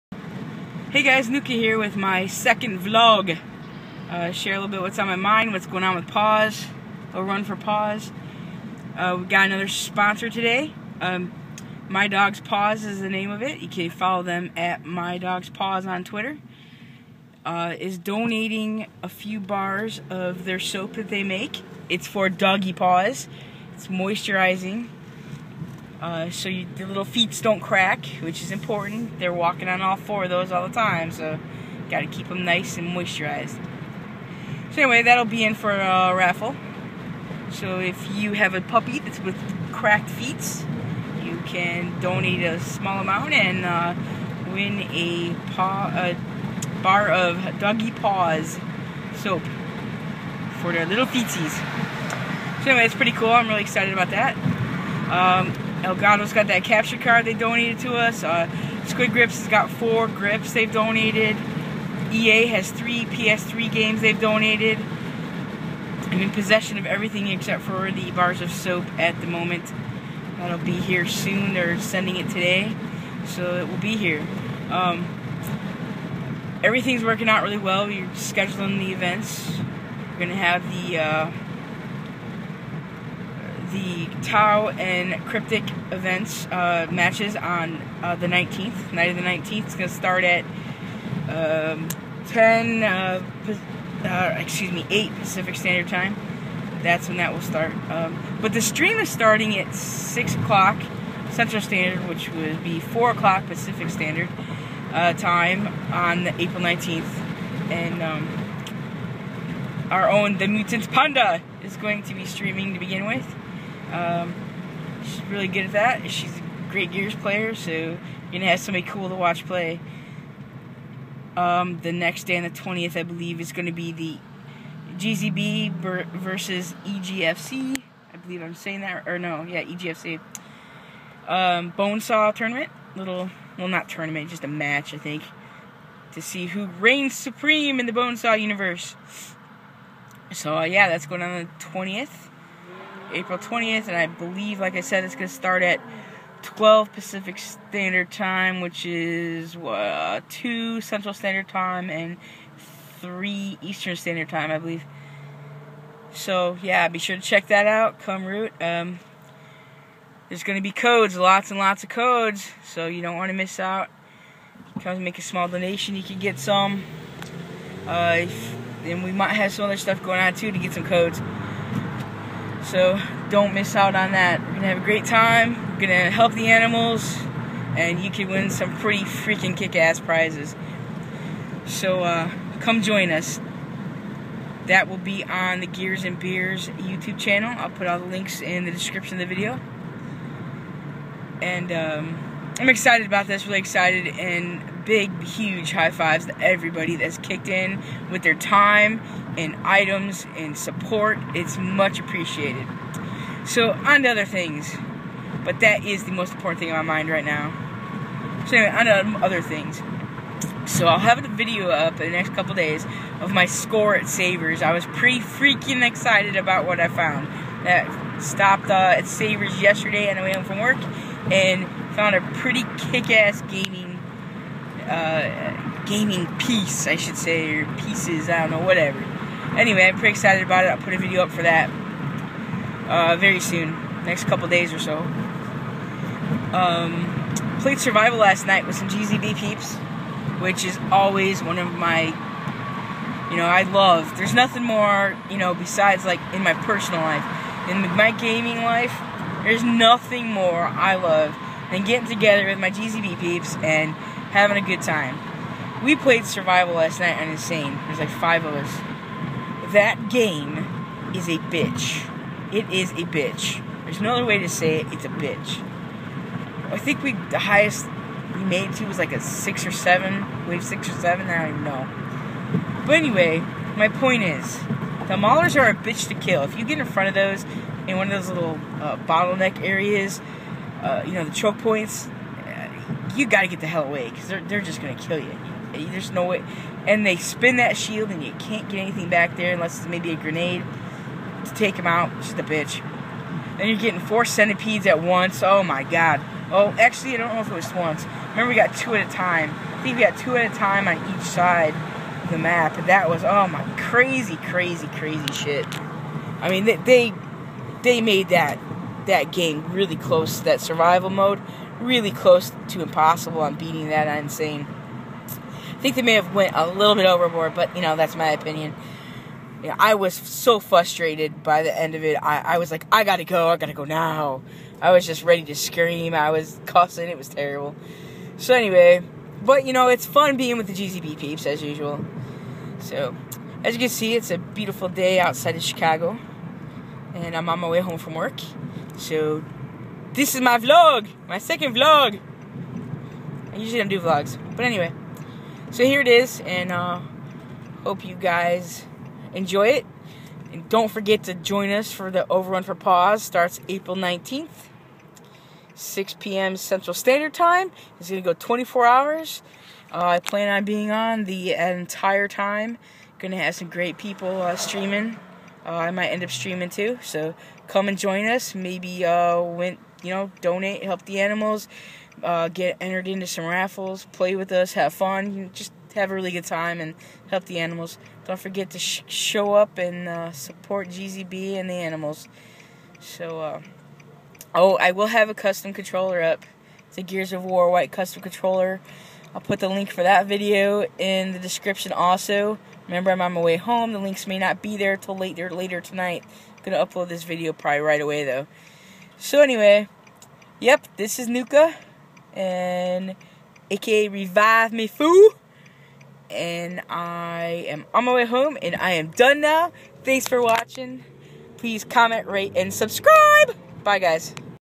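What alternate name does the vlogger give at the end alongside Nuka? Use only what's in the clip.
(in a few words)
Revive Me Fool.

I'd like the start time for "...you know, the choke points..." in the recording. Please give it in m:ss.
4:41.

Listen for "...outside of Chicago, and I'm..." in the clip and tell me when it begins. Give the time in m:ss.
5:35.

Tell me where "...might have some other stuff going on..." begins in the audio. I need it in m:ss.
2:49.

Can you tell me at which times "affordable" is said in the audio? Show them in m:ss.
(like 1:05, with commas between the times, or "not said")
not said.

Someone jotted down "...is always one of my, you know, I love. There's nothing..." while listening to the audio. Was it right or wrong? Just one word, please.
right.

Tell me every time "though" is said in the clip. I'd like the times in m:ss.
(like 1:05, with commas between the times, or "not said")
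6:38.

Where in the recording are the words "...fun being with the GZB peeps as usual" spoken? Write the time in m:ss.
5:30.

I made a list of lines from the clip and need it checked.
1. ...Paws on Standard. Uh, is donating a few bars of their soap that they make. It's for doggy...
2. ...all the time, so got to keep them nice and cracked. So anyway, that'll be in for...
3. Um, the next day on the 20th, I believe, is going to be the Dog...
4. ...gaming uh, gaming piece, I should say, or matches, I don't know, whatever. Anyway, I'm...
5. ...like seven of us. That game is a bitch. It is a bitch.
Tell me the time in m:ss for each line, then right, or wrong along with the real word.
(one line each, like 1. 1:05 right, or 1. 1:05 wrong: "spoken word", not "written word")
1. 0:15 wrong: "Twitter", not "Standard"
2. 0:30 wrong: "moisturized", not "cracked"
3. 2:01 wrong: "GZB", not "Dog"
4. 3:43 wrong: "pieces", not "matches"
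5. 4:17 wrong: "five", not "seven".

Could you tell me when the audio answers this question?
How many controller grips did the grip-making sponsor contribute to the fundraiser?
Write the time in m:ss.
0:59.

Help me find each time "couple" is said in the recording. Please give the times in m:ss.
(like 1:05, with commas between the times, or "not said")
3:32, 3:54.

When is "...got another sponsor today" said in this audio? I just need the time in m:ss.
0:09.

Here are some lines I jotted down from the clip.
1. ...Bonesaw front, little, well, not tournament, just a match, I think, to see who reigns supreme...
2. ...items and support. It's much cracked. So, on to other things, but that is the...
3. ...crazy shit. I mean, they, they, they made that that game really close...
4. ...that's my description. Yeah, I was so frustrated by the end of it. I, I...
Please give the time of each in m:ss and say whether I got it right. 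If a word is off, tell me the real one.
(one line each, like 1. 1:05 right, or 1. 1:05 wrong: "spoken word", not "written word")
1. 2:11 wrong: "tournament", not "front"
2. 3:19 wrong: "appreciated", not "cracked"
3. 5:04 right
4. 5:17 wrong: "opinion", not "description".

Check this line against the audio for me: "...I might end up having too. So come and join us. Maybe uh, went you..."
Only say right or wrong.
wrong.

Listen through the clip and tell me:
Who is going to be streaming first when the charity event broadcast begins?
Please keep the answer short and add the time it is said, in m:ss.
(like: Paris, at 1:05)
The Mutant Panda, at 1:50.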